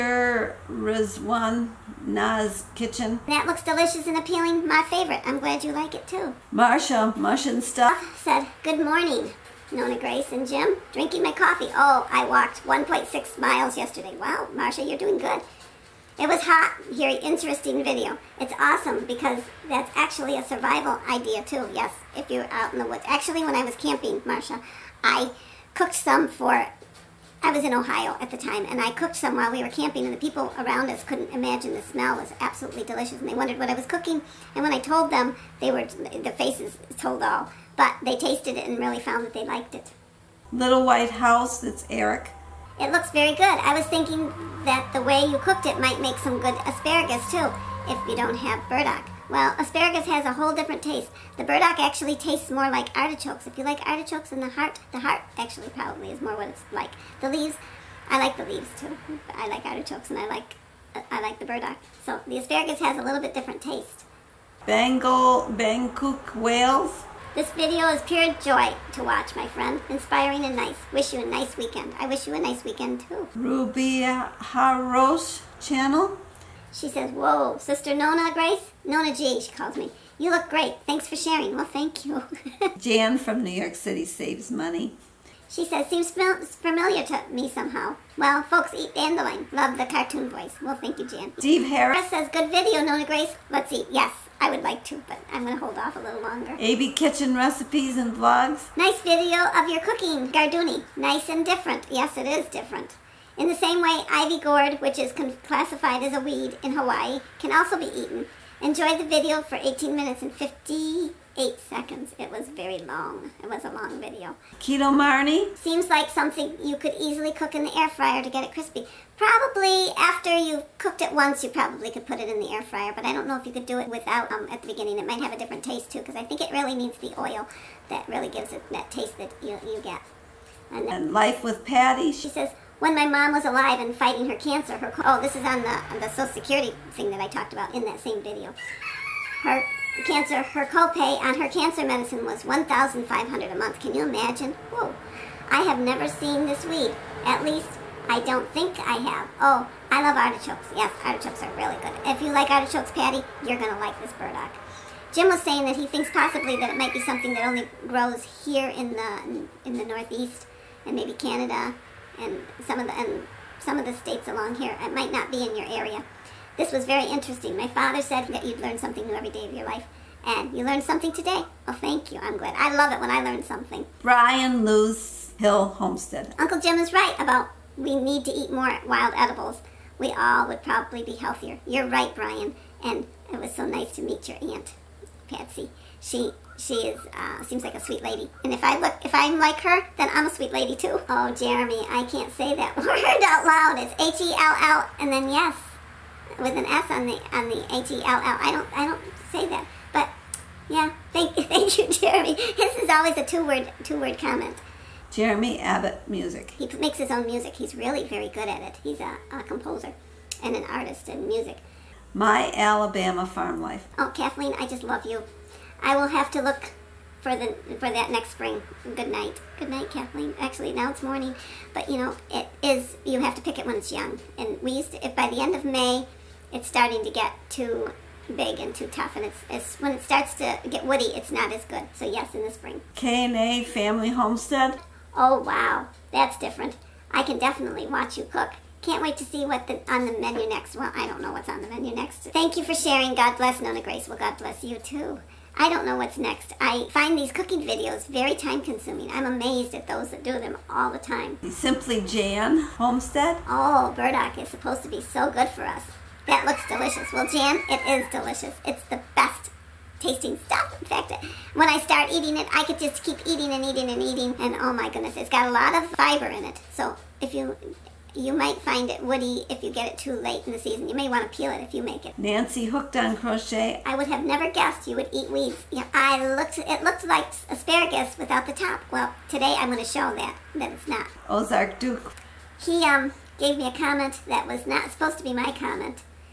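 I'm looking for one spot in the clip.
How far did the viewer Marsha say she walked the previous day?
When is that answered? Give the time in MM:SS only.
00:12.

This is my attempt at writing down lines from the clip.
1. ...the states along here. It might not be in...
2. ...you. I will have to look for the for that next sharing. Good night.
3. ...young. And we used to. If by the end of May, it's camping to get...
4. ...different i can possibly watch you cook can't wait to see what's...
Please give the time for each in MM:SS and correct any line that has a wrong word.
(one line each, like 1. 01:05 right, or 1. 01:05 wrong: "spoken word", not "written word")
1. 02:43 right
2. 03:35 wrong: "spring", not "sharing"
3. 03:43 wrong: "starting", not "camping"
4. 03:56 wrong: "definitely", not "possibly".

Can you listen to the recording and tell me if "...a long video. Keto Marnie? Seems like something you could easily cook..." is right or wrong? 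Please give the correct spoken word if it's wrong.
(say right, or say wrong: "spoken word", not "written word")
right.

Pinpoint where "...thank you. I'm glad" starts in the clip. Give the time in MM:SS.
02:51.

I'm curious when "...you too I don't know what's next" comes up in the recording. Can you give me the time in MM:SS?
04:04.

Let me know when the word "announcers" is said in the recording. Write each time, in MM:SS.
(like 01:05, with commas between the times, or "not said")
not said.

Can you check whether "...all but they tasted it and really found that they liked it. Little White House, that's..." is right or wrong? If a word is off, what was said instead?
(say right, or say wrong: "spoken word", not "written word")
right.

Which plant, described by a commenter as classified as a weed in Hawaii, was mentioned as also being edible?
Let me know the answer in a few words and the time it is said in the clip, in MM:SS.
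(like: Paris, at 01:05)
ivy gourd, at 01:44.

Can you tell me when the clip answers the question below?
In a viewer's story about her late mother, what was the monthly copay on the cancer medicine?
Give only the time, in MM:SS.
02:22.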